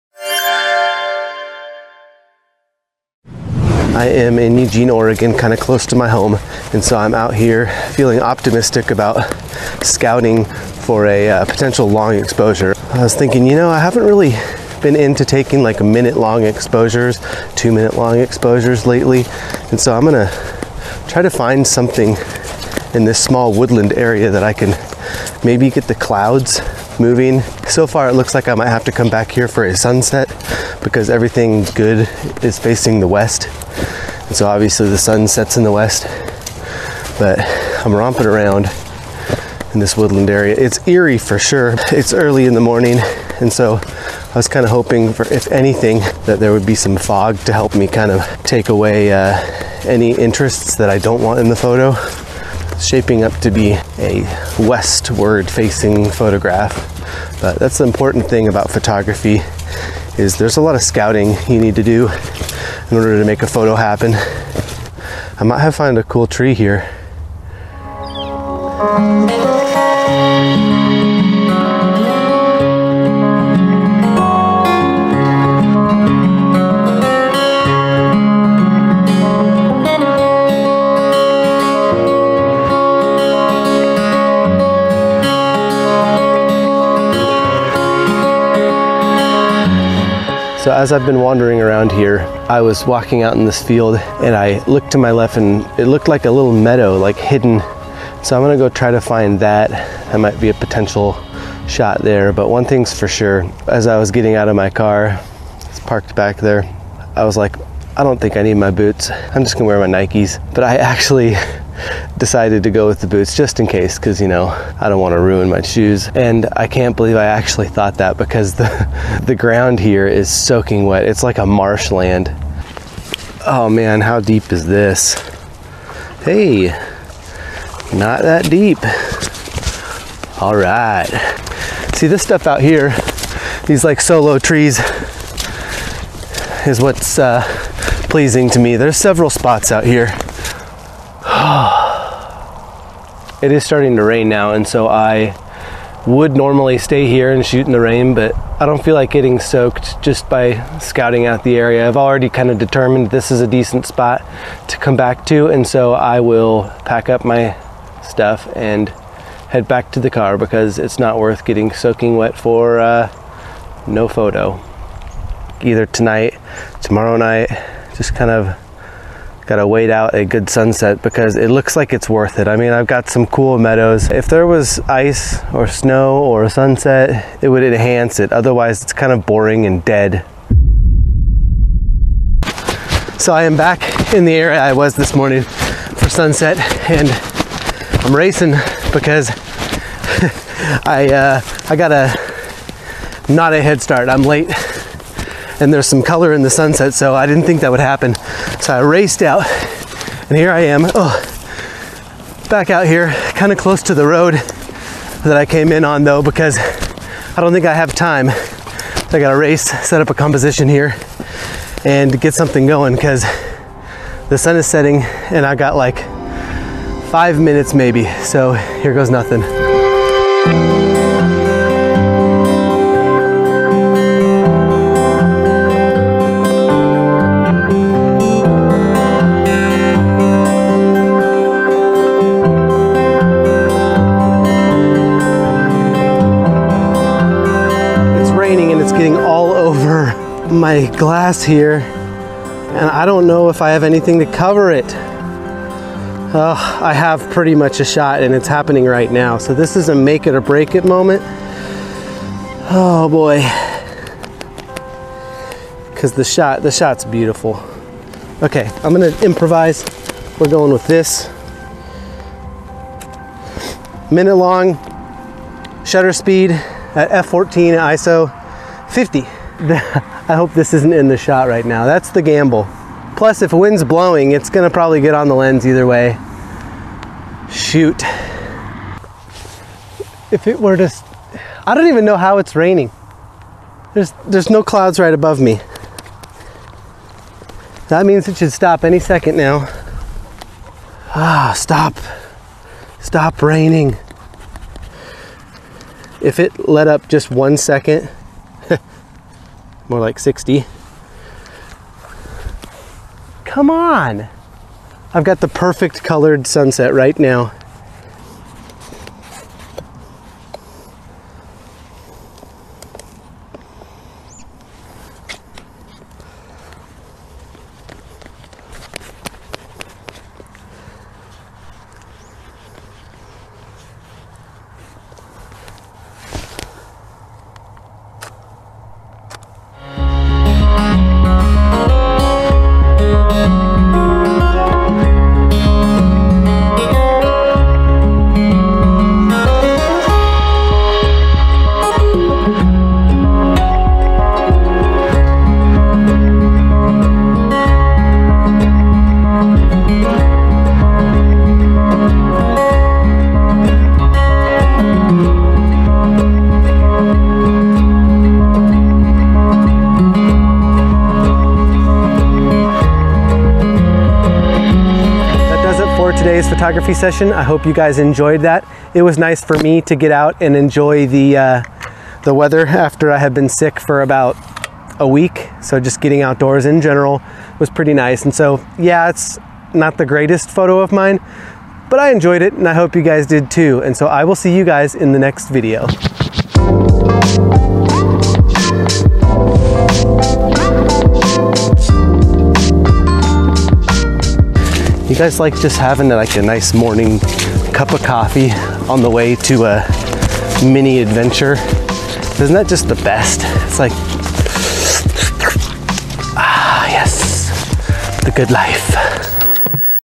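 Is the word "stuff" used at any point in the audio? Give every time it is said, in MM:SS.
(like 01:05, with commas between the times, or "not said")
02:12, 02:38.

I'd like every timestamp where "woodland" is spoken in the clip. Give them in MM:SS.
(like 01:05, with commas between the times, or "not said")
00:23, 00:39.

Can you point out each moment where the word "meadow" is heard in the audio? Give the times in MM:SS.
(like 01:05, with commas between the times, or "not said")
01:36, 02:53.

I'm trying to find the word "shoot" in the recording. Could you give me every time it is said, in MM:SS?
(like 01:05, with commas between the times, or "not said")
02:27, 04:37.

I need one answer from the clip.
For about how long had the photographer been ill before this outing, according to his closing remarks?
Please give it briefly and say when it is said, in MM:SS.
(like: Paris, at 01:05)
About a week, at 06:14.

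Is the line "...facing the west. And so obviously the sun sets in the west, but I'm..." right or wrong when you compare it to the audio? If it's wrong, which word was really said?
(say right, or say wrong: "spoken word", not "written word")
right.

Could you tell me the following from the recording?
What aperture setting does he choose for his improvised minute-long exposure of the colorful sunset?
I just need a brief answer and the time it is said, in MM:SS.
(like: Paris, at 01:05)
f14, at 04:27.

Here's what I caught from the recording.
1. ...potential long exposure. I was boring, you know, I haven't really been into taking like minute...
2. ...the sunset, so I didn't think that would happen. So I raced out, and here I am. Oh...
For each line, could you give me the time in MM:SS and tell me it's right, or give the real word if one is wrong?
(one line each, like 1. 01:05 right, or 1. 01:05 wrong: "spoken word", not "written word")
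1. 00:11 wrong: "thinking", not "boring"
2. 03:16 right.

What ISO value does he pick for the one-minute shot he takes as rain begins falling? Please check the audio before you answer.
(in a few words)
50.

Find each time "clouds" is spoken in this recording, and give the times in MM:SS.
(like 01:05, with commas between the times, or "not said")
00:25, 04:44.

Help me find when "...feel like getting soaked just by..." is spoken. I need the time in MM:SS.
02:28.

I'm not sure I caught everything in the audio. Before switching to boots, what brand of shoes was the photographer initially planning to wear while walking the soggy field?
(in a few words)
Nikes.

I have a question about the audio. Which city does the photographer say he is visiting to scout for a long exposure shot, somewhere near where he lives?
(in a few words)
Eugene, Oregon.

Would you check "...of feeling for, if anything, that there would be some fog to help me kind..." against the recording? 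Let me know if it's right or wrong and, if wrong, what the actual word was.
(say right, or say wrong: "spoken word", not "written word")
wrong: "hoping", not "feeling".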